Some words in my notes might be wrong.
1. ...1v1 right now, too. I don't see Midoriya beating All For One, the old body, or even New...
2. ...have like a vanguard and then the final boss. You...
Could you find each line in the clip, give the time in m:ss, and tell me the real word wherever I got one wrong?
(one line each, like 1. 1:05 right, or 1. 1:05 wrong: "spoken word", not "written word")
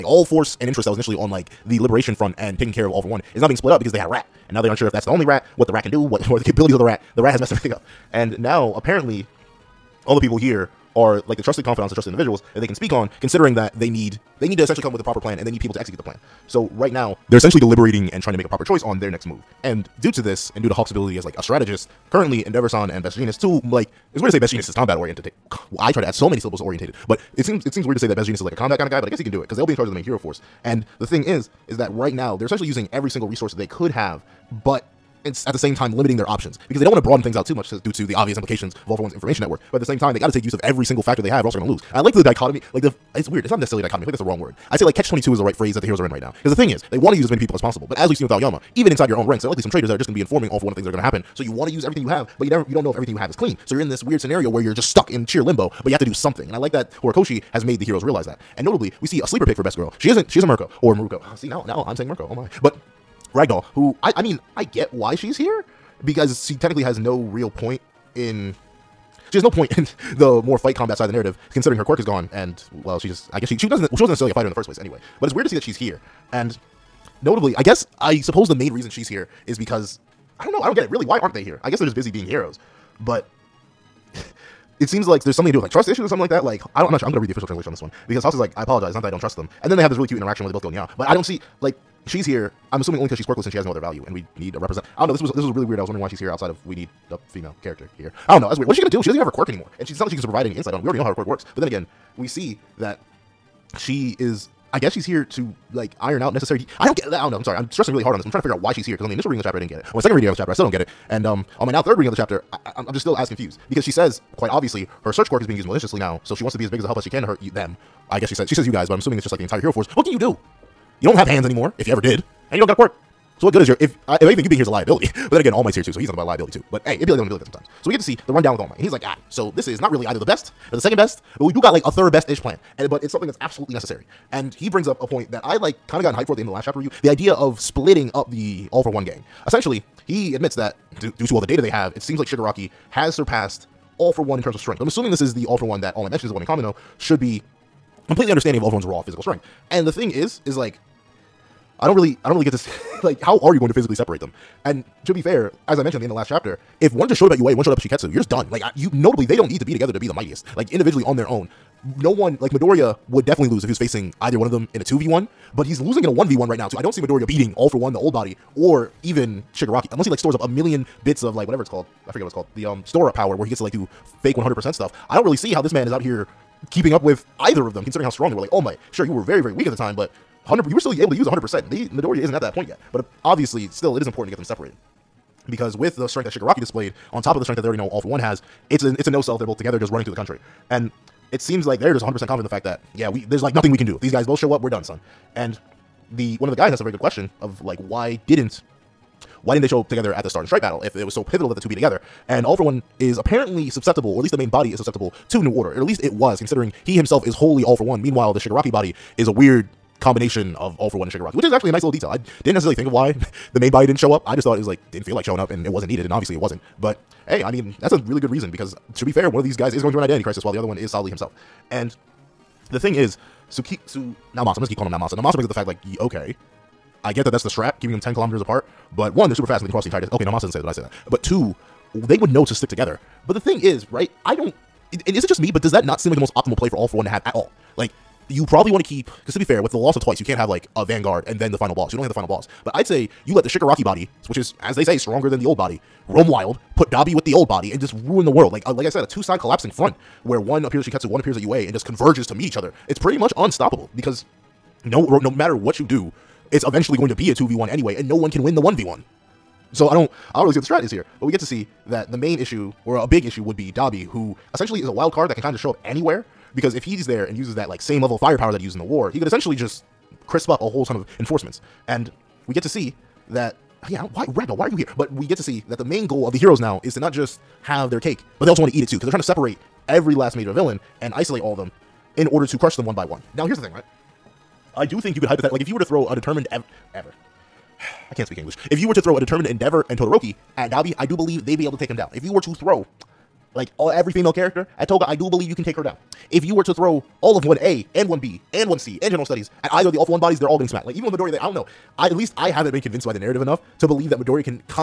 1. 2:46 wrong: "Shigaraki", not "New"
2. 4:00 right.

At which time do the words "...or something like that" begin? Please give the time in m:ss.
1:26.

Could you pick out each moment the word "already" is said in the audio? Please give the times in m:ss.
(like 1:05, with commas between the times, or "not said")
1:40, 3:07.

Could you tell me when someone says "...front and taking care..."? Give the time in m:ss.
0:02.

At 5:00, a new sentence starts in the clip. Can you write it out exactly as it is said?
Like even with Midoriya there, I don't know.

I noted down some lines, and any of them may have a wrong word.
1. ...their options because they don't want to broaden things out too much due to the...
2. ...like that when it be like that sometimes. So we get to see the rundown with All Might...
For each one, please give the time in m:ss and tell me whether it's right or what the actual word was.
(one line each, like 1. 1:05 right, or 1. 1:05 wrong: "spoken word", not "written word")
1. 0:36 right
2. 2:07 right.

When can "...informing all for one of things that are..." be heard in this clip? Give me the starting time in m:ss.
0:50.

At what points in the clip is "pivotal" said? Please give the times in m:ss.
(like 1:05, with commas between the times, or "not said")
3:21.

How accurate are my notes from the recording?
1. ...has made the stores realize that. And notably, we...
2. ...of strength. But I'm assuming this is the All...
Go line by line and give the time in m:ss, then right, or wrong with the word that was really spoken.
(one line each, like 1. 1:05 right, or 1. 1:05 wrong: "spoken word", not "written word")
1. 0:57 wrong: "heroes", not "stores"
2. 2:24 right.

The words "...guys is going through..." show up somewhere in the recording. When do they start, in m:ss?
3:39.